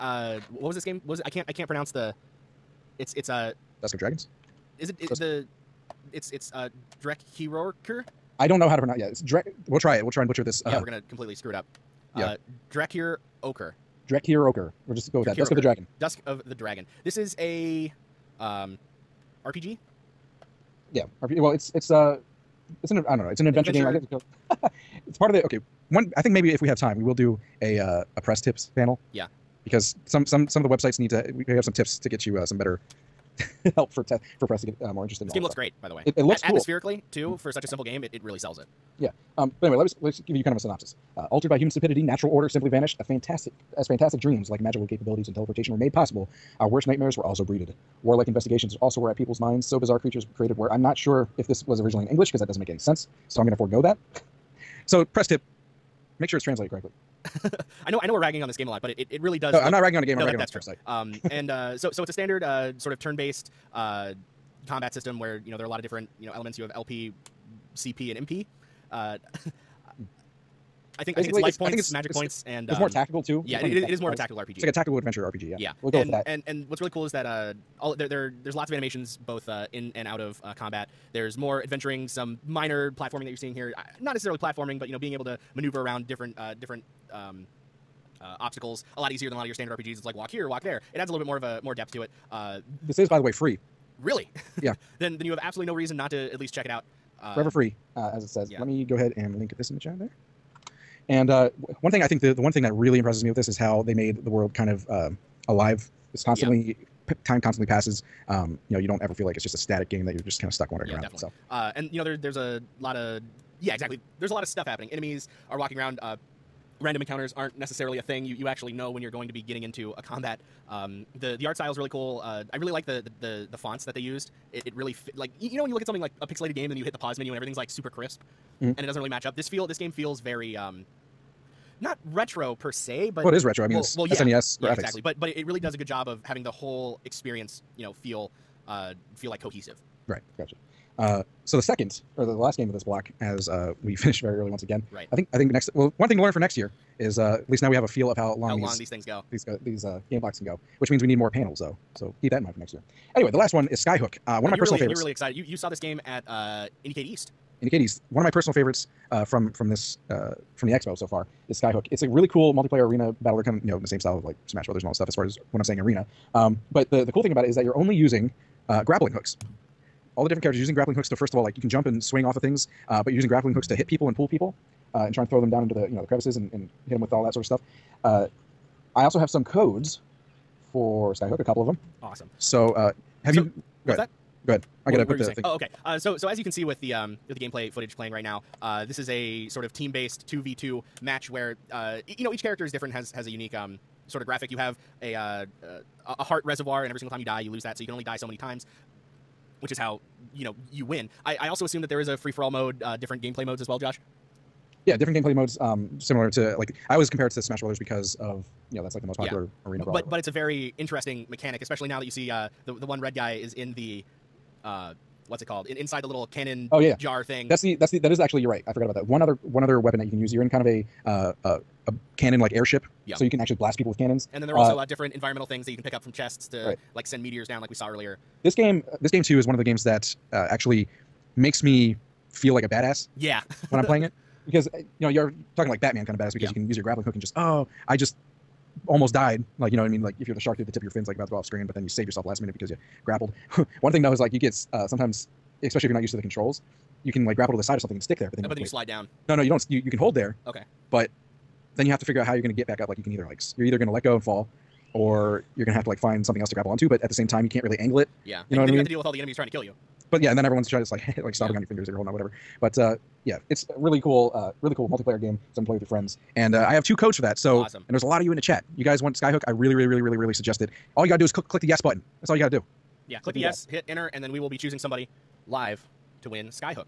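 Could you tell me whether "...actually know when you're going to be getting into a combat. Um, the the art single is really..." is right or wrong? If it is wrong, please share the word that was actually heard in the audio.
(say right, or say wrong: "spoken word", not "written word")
wrong: "style", not "single".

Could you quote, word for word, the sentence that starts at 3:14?
You have a uh, uh a heart reservoir, and every single time you die, you lose that.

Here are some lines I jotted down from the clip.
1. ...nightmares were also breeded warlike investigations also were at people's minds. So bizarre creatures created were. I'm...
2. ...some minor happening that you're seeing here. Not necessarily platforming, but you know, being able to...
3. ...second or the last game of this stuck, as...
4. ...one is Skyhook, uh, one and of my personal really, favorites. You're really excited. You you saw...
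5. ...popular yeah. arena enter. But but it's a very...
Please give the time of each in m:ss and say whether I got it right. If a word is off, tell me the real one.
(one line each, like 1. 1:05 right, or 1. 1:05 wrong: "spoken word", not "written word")
1. 0:46 right
2. 1:22 wrong: "platforming", not "happening"
3. 2:21 wrong: "block", not "stuck"
4. 2:33 right
5. 3:29 wrong: "brawler", not "enter".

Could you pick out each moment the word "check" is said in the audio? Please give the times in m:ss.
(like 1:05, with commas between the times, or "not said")
1:36.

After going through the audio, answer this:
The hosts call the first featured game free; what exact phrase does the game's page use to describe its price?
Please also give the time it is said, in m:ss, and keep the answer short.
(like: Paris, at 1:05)
Forever free, at 1:37.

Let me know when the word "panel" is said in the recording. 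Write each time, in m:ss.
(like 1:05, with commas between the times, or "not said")
0:28, 2:31.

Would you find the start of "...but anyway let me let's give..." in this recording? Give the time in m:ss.
0:39.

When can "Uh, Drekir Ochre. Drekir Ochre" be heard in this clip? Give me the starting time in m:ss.
0:12.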